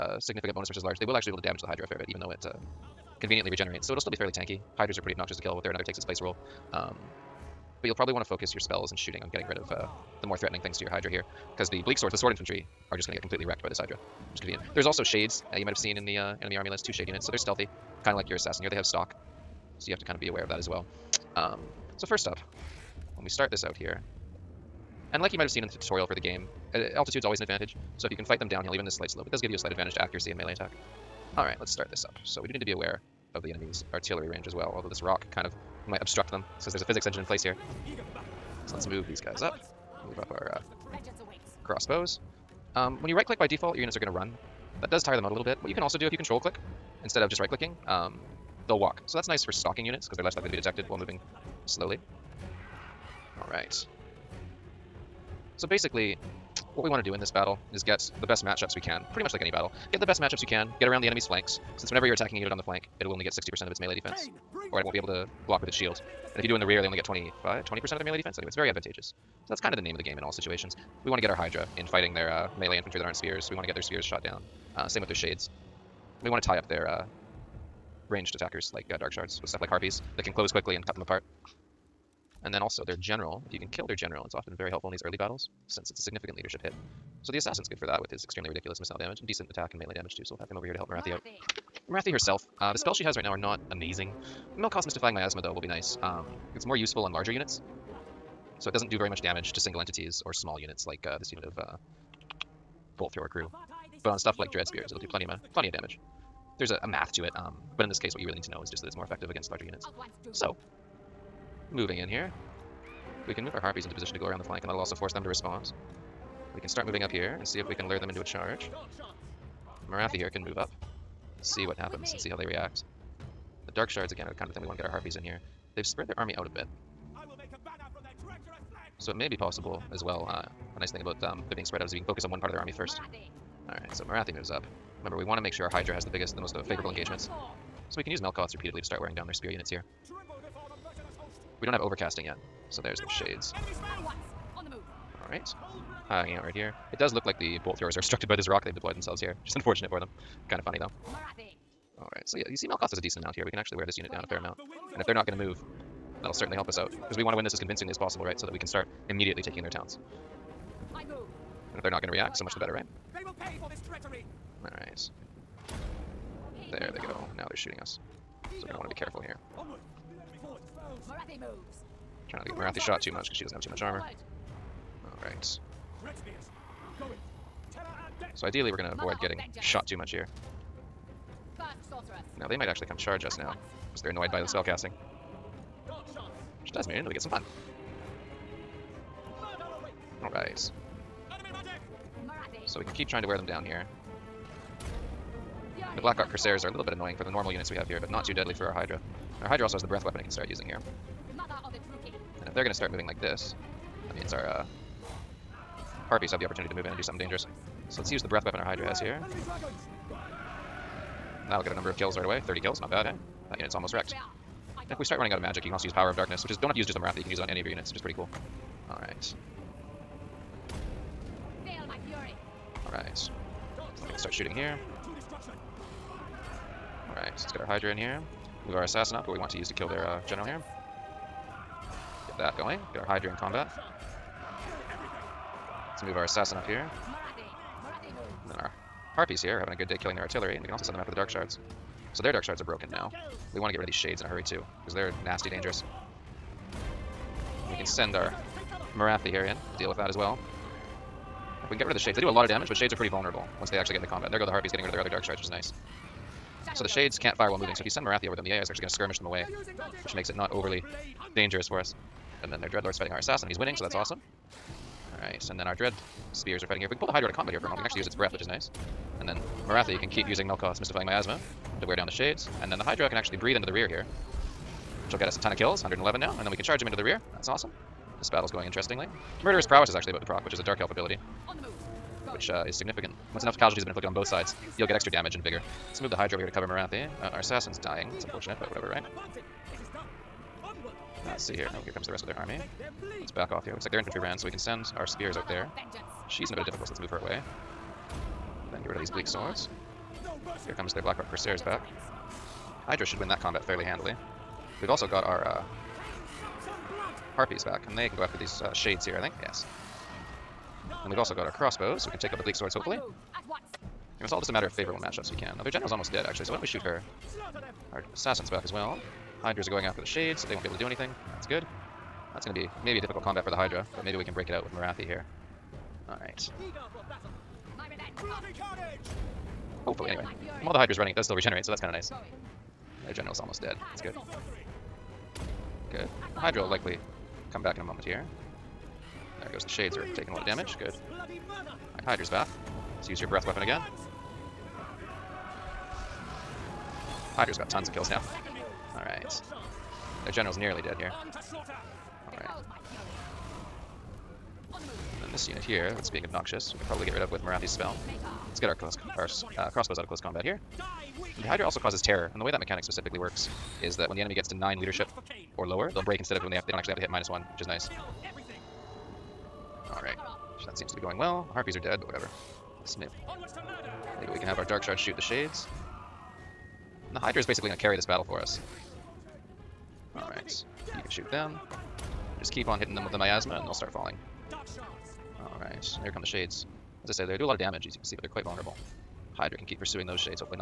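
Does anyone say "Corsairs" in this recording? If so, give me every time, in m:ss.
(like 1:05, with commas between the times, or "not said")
3:16, 5:01.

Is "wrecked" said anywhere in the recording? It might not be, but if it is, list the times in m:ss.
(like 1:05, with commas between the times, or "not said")
0:13, 3:33.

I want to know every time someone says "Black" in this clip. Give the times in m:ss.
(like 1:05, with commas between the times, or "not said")
3:16, 5:01.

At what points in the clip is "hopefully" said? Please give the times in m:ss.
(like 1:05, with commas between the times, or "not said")
5:12, 5:29.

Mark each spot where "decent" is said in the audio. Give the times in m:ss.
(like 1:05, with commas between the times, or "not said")
1:29, 2:33.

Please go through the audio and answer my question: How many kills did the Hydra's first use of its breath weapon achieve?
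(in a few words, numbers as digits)
30.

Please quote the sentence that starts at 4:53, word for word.
Looks like their infantry ran, so we can send our spears out there.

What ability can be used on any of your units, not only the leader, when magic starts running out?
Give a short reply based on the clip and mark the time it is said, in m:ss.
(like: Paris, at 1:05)
Power of Darkness, at 3:35.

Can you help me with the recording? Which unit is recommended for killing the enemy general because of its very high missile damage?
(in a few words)
The assassin.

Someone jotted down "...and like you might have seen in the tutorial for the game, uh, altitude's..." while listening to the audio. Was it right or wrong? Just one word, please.
right.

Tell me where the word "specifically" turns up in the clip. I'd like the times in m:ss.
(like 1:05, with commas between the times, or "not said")
6:02.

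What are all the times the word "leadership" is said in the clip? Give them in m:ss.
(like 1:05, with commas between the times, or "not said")
1:26, 6:04.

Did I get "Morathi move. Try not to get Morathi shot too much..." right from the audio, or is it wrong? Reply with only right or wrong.
right.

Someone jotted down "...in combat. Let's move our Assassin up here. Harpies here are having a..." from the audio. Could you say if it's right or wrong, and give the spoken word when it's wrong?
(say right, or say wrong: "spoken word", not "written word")
right.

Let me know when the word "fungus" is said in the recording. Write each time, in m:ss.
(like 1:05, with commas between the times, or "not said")
not said.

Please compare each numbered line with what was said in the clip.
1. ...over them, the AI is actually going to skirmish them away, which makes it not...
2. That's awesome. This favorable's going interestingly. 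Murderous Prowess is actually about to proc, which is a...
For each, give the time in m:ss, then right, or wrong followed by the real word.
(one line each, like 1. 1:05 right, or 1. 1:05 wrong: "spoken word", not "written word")
1. 4:18 right
2. 4:37 wrong: "battle", not "favorable".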